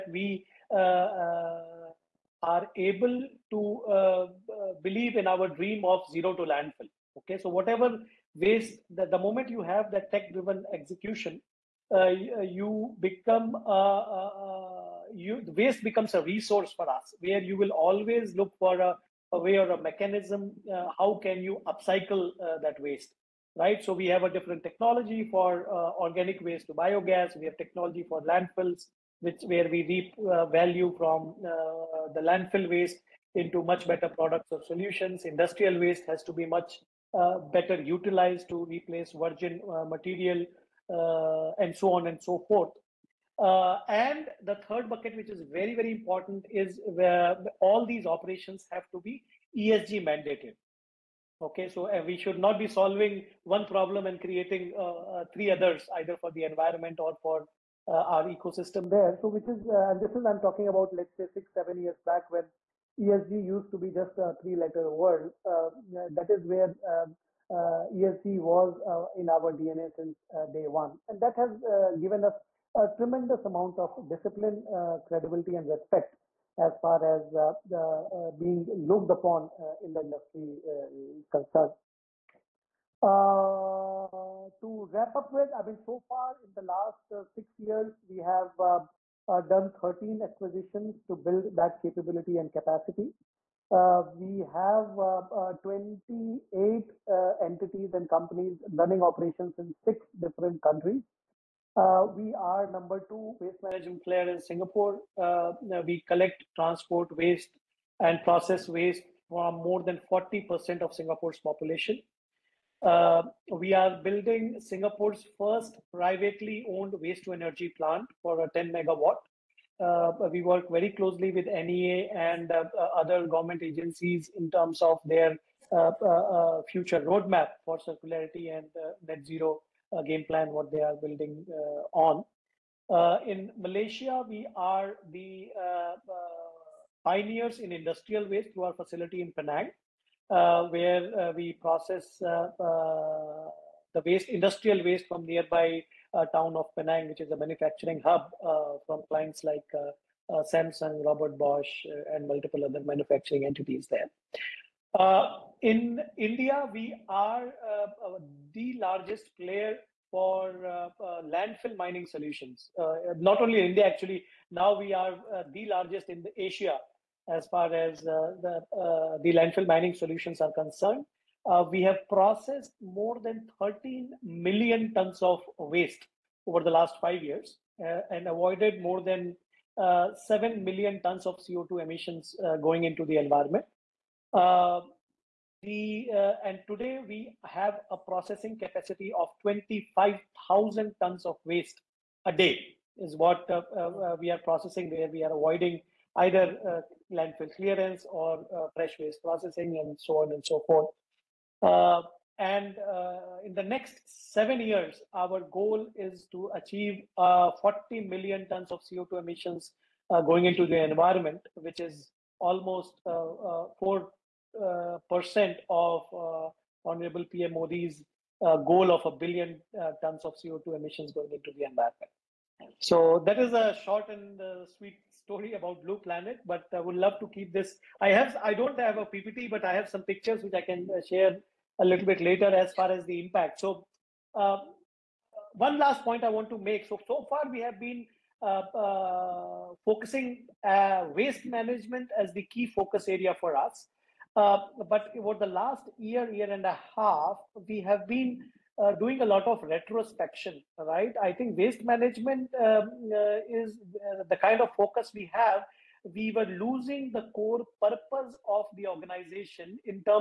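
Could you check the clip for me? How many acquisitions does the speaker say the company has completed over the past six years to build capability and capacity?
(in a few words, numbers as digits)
13.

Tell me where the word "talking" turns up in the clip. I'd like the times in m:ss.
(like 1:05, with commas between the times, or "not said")
1:00.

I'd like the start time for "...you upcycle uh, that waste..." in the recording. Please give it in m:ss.
0:21.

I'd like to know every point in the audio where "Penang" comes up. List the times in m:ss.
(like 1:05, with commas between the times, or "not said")
2:19, 2:26.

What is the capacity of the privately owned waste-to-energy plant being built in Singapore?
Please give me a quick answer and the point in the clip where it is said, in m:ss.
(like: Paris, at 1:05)
10 megawatts, at 1:58.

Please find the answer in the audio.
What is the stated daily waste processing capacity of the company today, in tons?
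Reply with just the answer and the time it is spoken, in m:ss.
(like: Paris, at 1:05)
25,000 tons, at 3:09.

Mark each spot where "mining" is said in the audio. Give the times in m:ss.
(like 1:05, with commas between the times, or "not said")
2:41, 2:49.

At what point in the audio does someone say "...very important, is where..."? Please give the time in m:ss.
0:45.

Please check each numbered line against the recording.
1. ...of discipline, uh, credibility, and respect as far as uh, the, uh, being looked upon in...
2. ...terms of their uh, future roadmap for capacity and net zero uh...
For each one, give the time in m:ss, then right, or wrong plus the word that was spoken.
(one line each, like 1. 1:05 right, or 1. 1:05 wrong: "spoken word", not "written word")
1. 1:13 right
2. 2:04 wrong: "circularity", not "capacity".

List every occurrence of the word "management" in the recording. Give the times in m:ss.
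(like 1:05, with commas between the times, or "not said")
1:43, 4:01, 4:11.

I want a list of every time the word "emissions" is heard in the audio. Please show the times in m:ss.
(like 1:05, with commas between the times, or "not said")
3:01, 3:29, 3:40.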